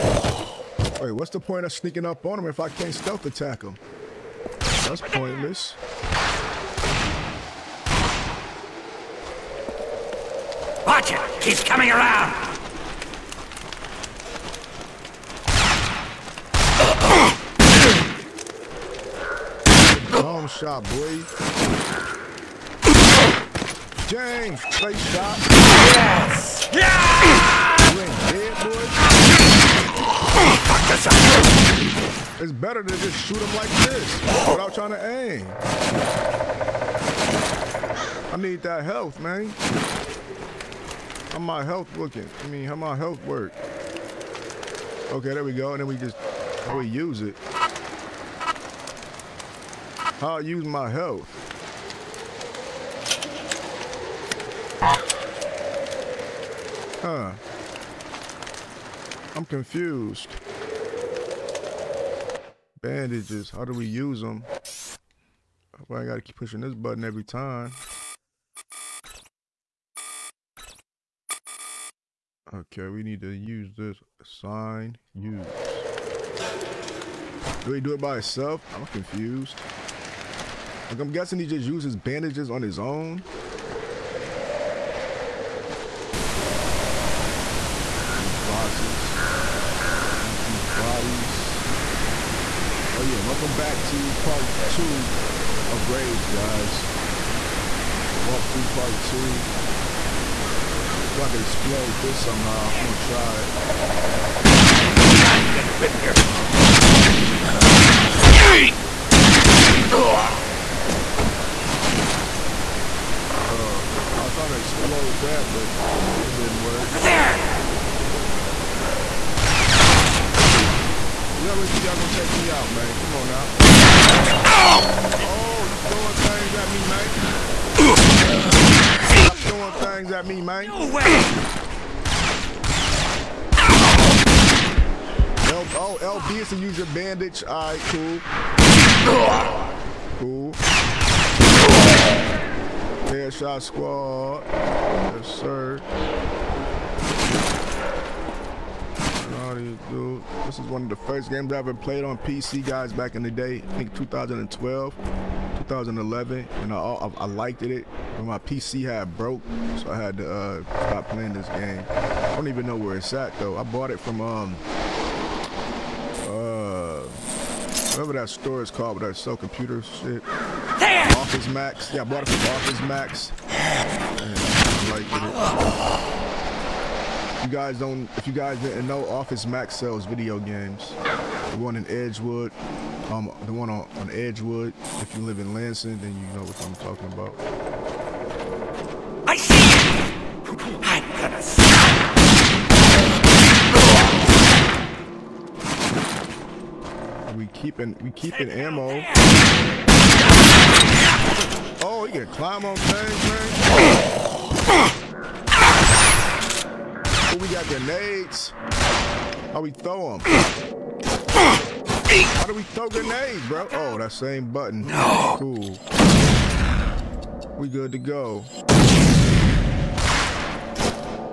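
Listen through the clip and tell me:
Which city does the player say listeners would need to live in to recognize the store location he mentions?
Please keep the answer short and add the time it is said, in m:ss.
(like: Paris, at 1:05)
Lansing, at 3:05.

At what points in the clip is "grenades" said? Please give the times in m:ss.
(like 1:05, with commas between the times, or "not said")
3:27, 3:32.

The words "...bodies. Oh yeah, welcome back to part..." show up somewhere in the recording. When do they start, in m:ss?
1:30.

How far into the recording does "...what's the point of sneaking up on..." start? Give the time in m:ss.
0:01.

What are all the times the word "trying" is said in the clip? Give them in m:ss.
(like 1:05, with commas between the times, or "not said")
0:34, 1:54.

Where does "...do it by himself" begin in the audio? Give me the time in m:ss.
1:17.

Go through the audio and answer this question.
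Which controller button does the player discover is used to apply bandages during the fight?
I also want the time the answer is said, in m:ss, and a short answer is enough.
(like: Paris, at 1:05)
LB, at 2:16.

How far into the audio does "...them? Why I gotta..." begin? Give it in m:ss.
1:04.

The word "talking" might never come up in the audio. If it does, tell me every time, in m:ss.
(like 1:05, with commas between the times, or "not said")
3:06.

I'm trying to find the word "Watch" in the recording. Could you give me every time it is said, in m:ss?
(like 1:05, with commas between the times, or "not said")
0:10.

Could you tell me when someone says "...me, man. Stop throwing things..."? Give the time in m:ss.
2:06.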